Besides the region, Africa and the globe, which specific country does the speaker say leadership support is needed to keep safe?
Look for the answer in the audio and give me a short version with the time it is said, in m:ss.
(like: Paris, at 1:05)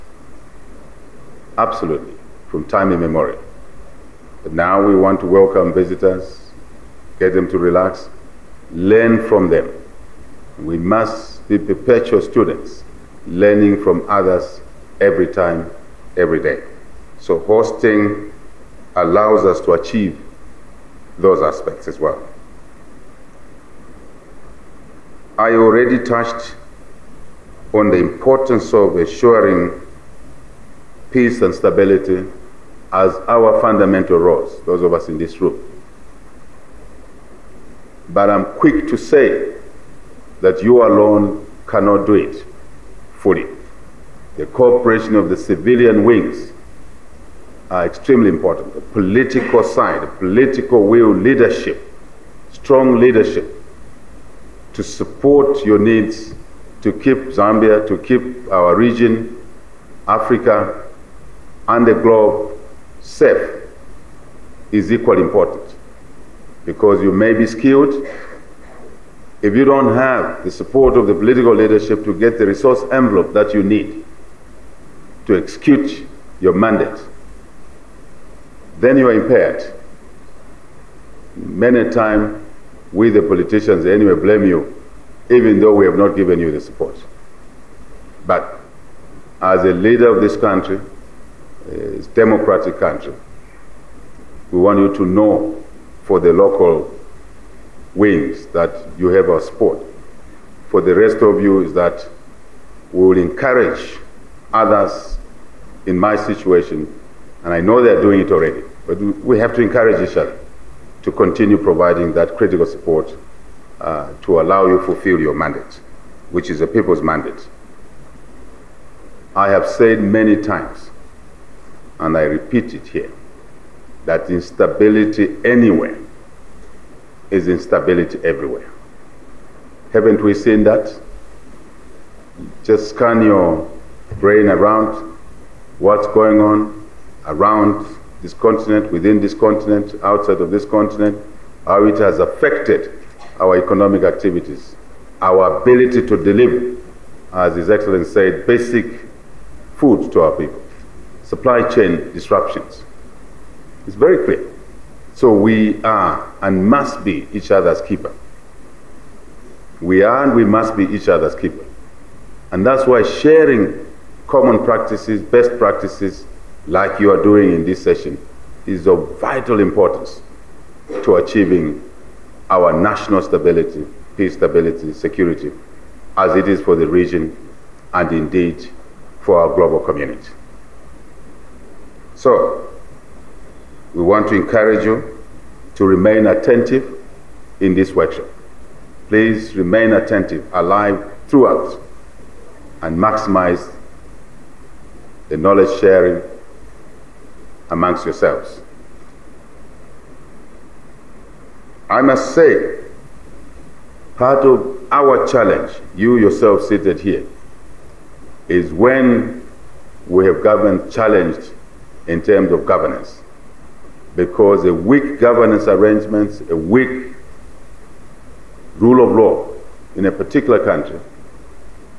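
Zambia, at 0:57.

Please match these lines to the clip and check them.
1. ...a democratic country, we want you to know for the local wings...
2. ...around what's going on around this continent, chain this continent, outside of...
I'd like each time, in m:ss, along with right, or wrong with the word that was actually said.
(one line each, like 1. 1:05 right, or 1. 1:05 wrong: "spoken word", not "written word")
1. 1:31 right
2. 2:14 wrong: "within", not "chain".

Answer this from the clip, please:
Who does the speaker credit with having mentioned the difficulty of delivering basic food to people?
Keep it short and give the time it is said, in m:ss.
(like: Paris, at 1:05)
His Excellency, at 2:27.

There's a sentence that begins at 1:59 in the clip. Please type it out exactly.
I have said many times, and I repeat it here, that instability anywhere is instability everywhere.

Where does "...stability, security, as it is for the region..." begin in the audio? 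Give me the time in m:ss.
2:54.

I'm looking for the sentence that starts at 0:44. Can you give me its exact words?
The cooperation of the civilian wings are extremely important.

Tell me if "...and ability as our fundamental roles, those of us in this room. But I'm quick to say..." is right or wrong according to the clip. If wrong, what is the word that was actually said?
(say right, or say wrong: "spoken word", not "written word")
wrong: "stability", not "ability".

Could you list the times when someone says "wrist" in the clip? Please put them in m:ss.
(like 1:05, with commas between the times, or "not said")
not said.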